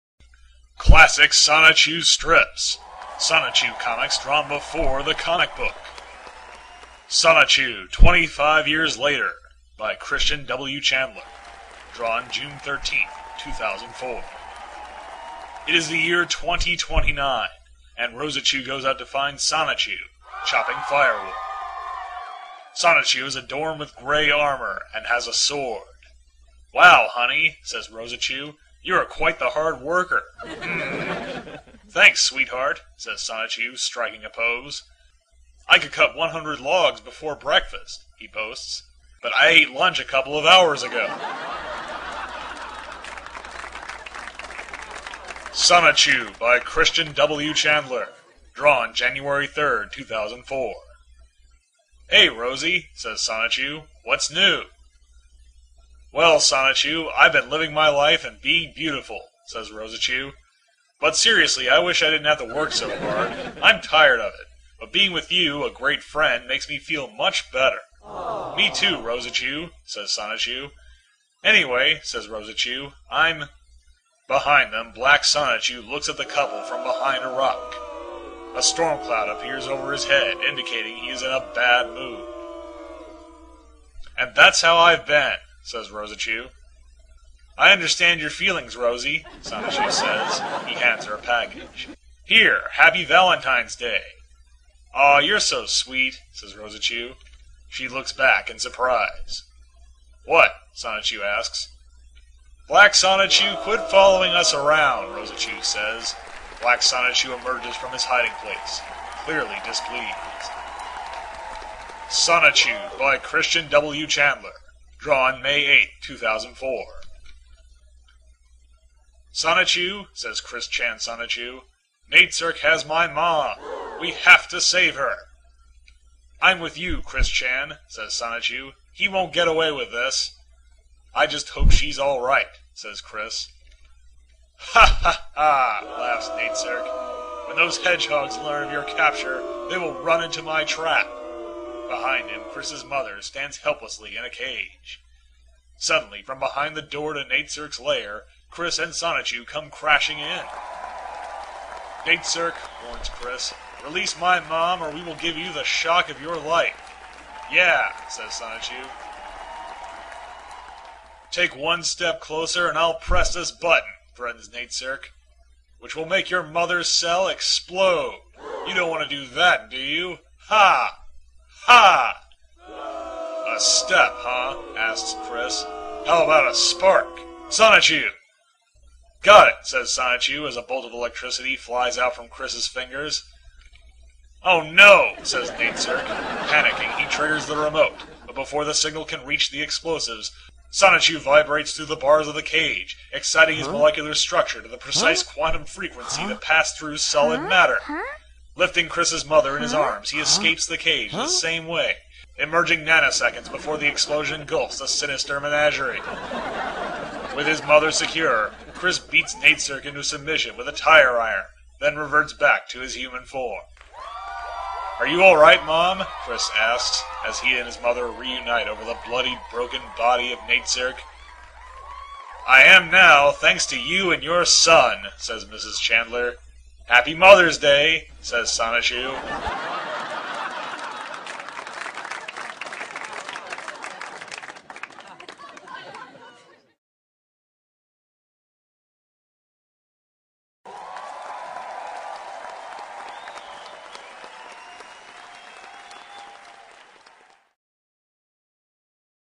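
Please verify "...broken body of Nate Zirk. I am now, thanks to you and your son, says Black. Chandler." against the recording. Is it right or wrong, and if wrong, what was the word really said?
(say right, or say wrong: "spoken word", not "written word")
wrong: "Mrs", not "Black".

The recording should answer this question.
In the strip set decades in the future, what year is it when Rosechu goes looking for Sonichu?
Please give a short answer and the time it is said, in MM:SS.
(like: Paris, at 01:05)
2029, at 00:16.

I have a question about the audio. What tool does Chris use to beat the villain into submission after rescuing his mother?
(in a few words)
tire iron.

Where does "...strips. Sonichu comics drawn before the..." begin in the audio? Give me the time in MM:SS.
00:02.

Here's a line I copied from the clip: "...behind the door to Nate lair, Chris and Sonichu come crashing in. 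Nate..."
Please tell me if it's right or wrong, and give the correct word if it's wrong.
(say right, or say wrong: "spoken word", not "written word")
right.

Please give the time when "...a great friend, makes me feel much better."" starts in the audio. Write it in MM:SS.
01:05.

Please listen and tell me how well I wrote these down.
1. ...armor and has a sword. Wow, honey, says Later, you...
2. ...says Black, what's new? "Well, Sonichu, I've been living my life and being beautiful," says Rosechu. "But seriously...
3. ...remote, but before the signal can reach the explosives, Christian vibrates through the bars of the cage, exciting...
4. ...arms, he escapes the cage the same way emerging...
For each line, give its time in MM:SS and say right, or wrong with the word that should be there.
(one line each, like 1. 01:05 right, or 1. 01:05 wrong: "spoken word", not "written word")
1. 00:24 wrong: "Rosechu", not "Later"
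2. 00:52 wrong: "Sonichu", not "Black"
3. 03:07 wrong: "Sonichu", not "Christian"
4. 03:19 right.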